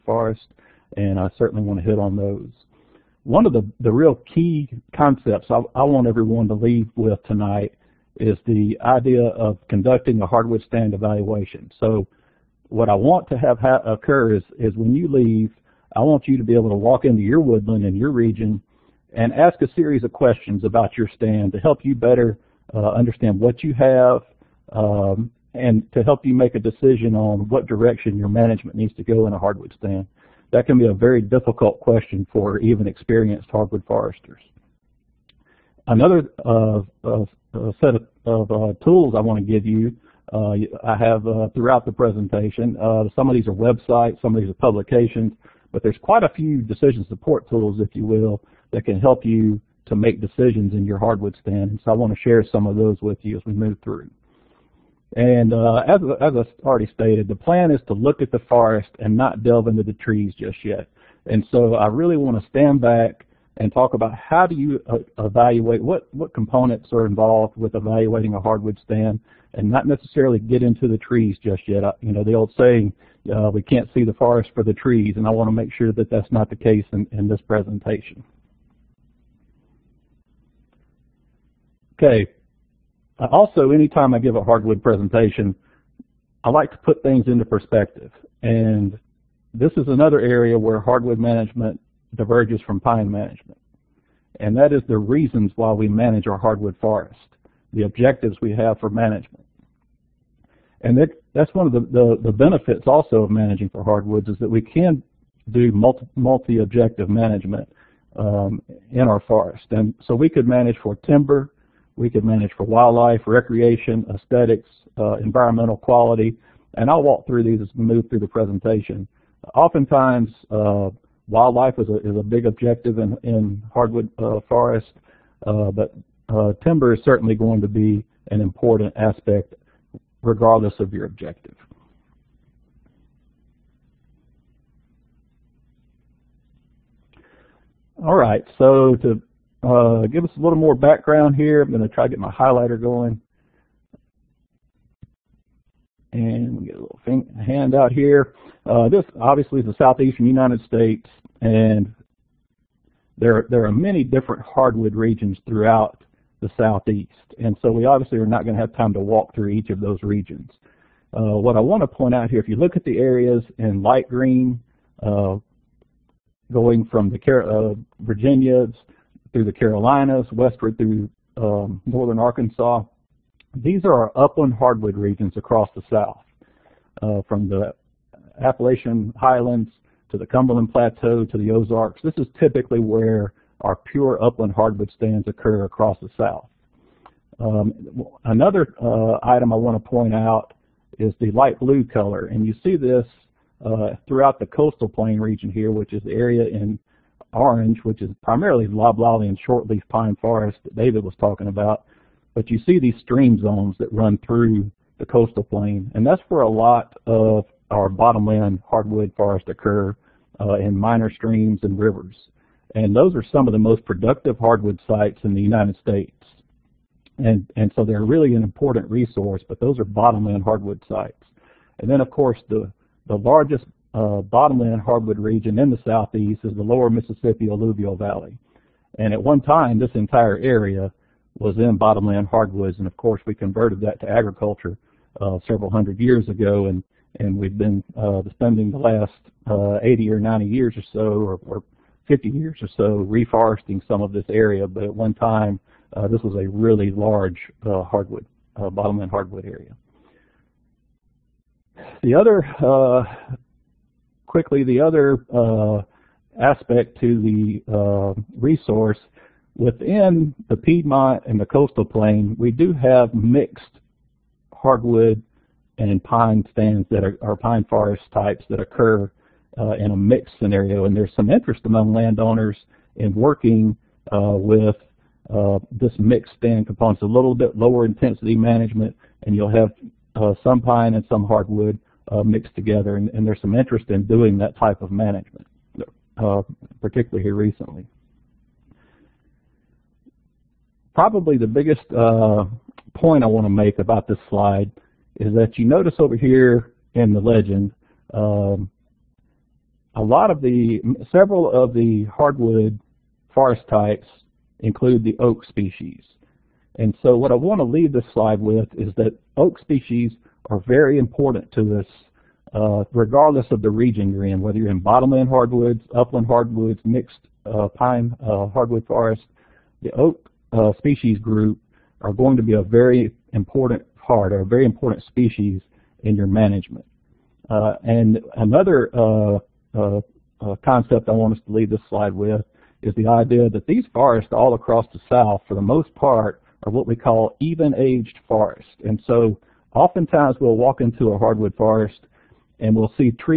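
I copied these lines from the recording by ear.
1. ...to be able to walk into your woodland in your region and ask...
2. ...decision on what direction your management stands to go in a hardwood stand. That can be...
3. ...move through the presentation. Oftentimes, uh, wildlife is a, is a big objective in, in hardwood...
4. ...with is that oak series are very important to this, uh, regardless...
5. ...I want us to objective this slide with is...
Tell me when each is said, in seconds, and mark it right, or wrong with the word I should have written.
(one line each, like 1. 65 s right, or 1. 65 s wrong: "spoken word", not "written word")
1. 16 s right
2. 26 s wrong: "needs", not "stands"
3. 117 s right
4. 308 s wrong: "species", not "series"
5. 331 s wrong: "leave", not "objective".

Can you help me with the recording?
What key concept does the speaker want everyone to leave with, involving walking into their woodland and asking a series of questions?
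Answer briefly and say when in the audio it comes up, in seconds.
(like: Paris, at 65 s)
Hardwood stand evaluation, at 10 s.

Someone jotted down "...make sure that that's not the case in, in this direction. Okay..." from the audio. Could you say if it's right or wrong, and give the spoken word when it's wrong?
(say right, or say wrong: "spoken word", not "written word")
wrong: "presentation", not "direction".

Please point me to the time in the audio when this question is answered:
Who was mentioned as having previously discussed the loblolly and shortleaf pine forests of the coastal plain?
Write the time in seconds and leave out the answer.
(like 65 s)
200 s.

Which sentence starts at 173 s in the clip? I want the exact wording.
These are our upland hardwood regions across the South, uh, from the Appalachian Highlands to the Cumberland Plateau to the Ozarks.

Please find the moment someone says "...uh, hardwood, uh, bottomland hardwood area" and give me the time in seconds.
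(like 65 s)
247 s.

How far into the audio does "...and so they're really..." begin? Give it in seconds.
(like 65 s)
217 s.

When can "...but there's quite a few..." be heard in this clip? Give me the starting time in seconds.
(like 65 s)
45 s.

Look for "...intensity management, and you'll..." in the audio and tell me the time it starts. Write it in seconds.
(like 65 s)
277 s.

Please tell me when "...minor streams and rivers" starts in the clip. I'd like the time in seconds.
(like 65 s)
210 s.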